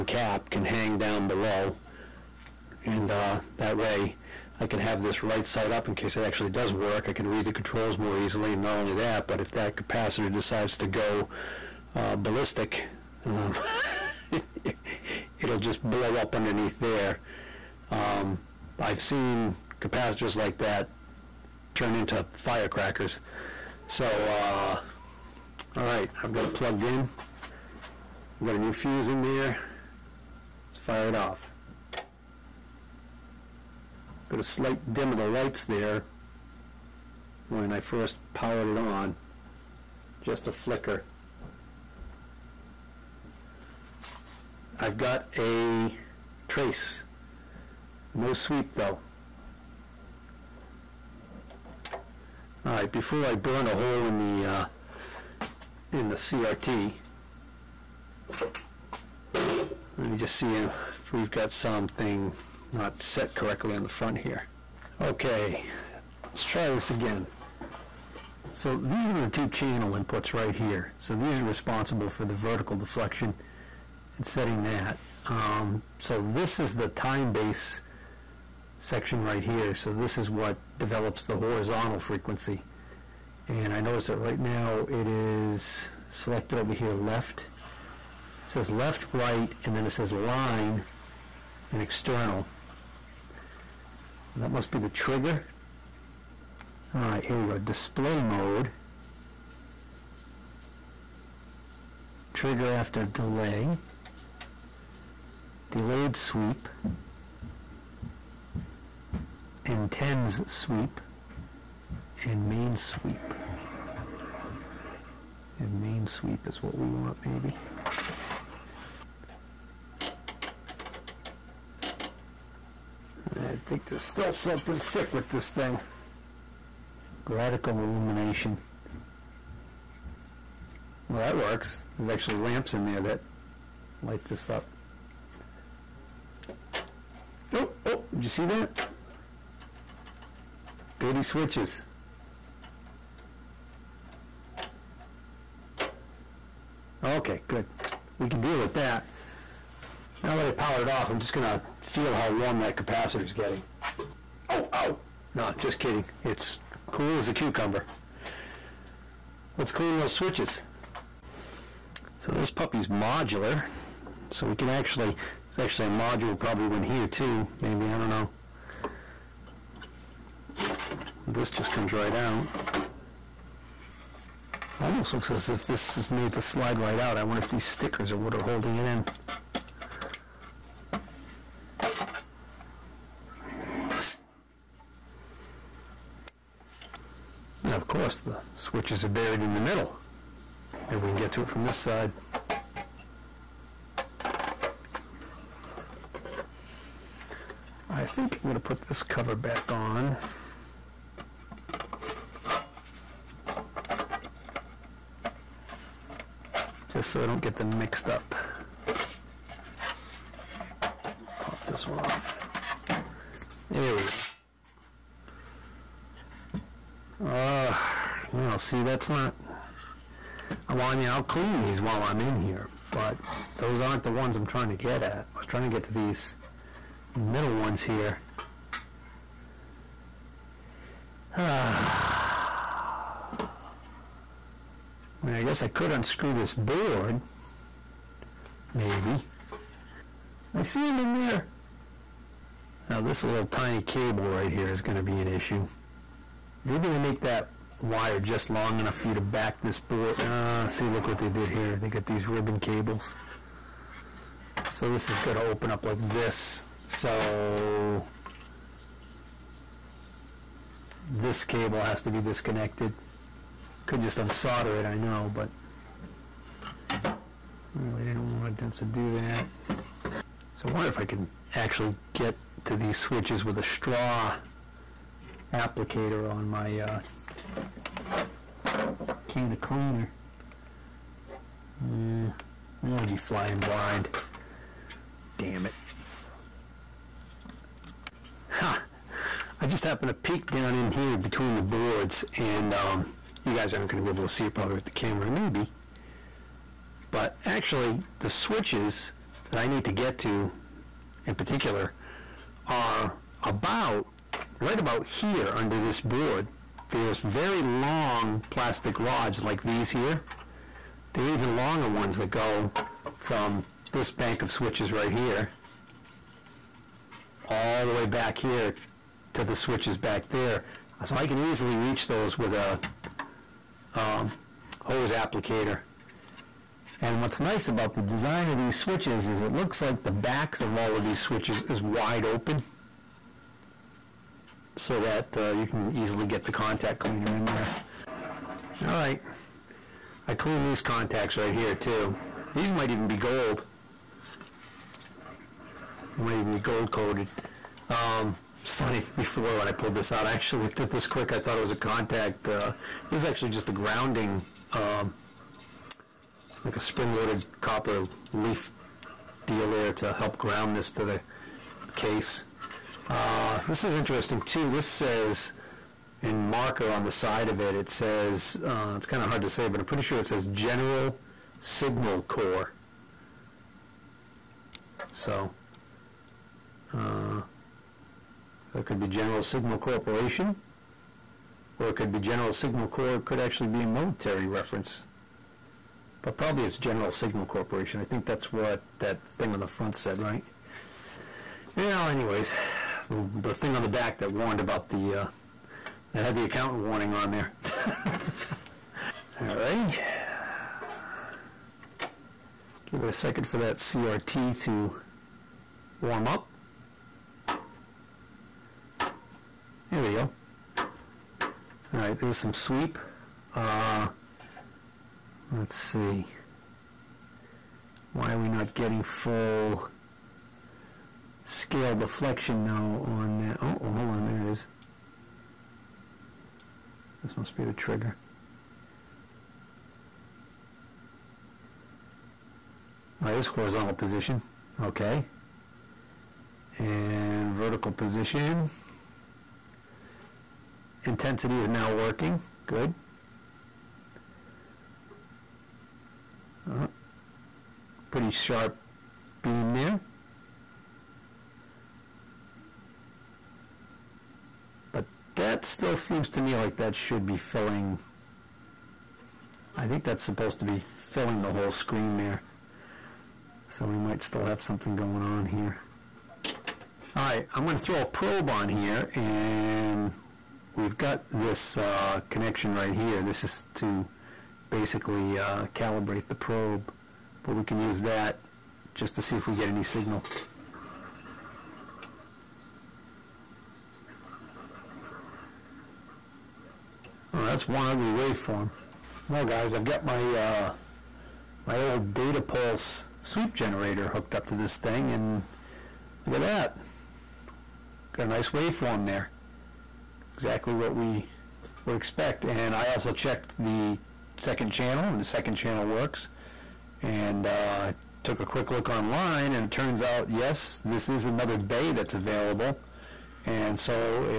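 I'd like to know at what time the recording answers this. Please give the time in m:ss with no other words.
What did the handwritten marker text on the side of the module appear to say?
6:10.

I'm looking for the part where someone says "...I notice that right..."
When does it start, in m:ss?
1:23.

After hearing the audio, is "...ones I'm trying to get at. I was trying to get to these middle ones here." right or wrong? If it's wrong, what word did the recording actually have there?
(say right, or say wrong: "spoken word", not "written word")
right.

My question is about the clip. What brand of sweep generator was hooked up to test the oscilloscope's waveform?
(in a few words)
Datapulse.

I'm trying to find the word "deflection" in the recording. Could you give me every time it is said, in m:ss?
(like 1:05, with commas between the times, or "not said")
1:12, 7:01.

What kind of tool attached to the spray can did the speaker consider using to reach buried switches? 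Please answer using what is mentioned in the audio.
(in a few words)
Straw applicator.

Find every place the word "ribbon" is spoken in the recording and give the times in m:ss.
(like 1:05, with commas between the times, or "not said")
4:12.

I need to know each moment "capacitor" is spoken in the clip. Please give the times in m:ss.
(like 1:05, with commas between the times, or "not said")
0:09, 0:19, 2:32.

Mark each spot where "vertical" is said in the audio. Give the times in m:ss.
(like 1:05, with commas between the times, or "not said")
1:12, 7:17.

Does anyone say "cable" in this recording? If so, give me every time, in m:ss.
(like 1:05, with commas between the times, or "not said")
4:03, 4:12, 4:21.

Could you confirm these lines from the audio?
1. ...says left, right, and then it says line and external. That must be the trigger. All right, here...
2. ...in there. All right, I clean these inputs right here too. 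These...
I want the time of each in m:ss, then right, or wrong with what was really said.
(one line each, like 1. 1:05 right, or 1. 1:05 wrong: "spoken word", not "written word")
1. 1:28 right
2. 5:37 wrong: "contacts", not "inputs".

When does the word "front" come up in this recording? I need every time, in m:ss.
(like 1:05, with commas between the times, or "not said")
1:03, 6:29.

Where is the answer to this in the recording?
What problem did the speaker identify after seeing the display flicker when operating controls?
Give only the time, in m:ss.
2:20.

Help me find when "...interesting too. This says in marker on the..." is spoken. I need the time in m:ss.
6:03.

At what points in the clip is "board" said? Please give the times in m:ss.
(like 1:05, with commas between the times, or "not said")
3:56, 4:09, 4:51, 5:06.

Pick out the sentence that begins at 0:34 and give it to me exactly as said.
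Got a slight dim of the lights there when I first powered it on.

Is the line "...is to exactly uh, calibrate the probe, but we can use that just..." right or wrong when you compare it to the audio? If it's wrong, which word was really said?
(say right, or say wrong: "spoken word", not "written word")
wrong: "basically", not "exactly".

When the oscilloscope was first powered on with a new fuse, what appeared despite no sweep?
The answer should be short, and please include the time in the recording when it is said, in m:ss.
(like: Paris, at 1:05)
A trace, at 0:44.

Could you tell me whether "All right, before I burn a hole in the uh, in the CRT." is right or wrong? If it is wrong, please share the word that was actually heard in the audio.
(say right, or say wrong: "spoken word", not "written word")
right.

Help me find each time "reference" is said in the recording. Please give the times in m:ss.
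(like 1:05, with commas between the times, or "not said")
6:24.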